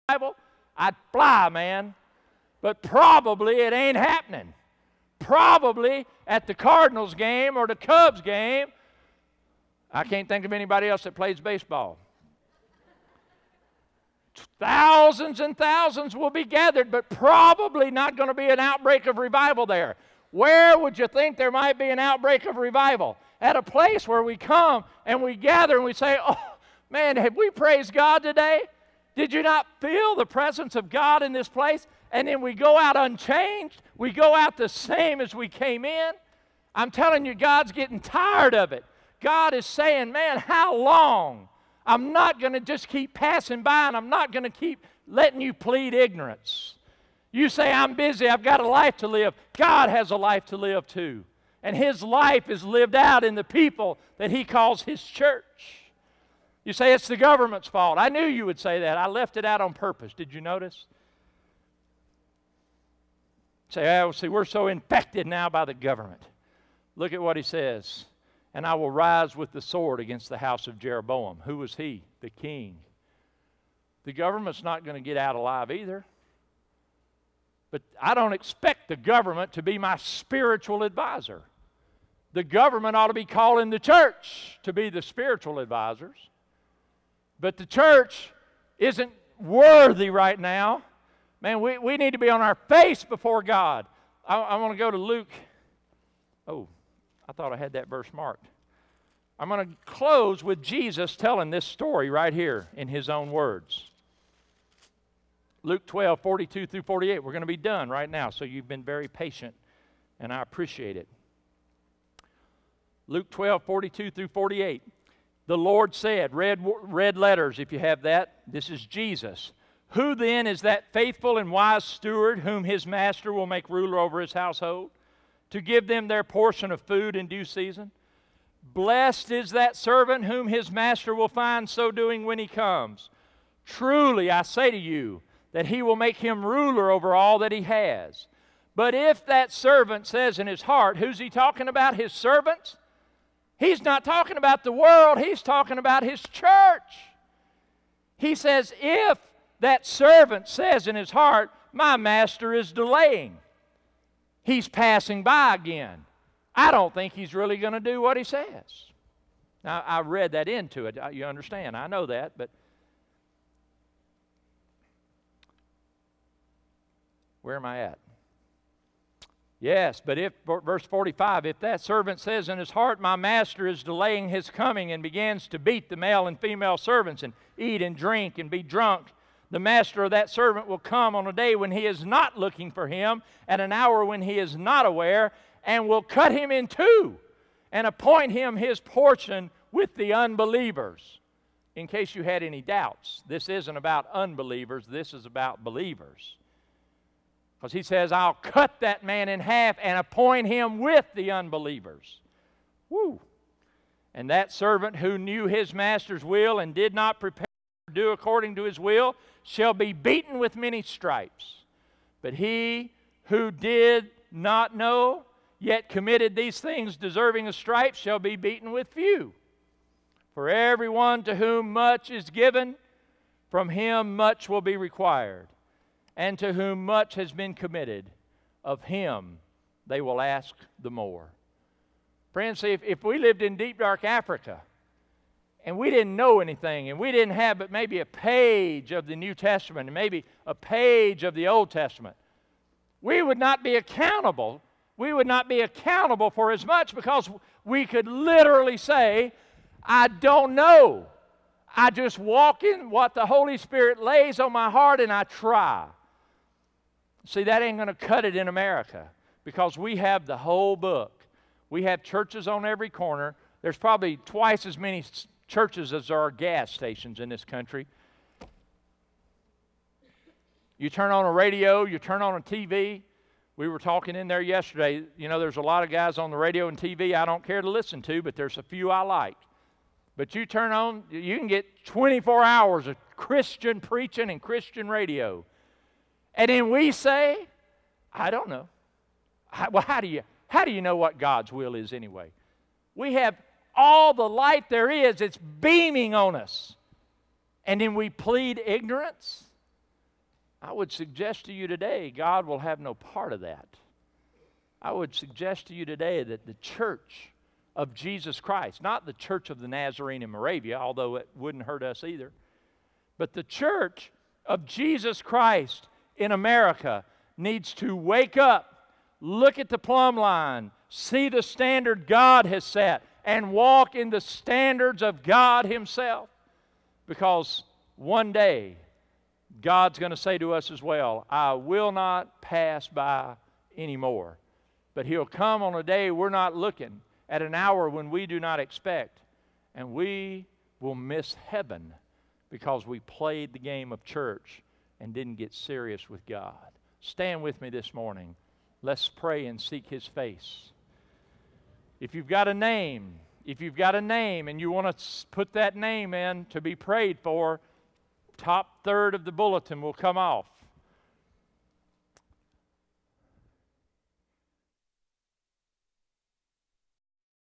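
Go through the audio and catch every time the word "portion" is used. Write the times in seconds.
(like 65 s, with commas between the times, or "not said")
126 s, 188 s.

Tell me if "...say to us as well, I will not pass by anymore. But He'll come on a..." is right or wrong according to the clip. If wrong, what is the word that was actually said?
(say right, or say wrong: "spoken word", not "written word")
right.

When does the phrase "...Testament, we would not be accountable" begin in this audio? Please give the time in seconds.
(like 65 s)
241 s.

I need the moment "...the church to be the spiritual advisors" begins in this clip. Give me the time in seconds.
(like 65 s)
83 s.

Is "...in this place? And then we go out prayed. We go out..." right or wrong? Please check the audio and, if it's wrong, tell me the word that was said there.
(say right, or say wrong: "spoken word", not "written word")
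wrong: "unchanged", not "prayed".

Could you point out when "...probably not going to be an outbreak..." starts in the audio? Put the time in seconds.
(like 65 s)
17 s.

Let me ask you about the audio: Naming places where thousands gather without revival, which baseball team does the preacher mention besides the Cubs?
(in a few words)
Cardinals.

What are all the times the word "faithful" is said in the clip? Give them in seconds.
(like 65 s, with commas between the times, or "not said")
120 s.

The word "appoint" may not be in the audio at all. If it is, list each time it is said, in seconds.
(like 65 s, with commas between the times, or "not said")
187 s, 199 s.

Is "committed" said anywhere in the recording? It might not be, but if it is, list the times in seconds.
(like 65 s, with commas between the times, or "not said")
215 s, 227 s.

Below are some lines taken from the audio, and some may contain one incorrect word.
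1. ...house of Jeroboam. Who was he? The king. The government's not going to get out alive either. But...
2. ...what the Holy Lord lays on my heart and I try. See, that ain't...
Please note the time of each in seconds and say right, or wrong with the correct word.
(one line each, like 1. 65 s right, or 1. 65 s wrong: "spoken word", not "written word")
1. 70 s right
2. 252 s wrong: "Spirit", not "Lord".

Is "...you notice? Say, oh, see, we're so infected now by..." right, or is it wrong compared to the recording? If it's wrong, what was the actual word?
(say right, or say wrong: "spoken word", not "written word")
right.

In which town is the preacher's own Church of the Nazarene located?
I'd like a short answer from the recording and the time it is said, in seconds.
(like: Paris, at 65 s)
Moravia, at 310 s.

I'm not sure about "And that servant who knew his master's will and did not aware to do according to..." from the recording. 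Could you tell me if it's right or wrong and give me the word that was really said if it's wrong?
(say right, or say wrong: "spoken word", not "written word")
wrong: "prepare", not "aware".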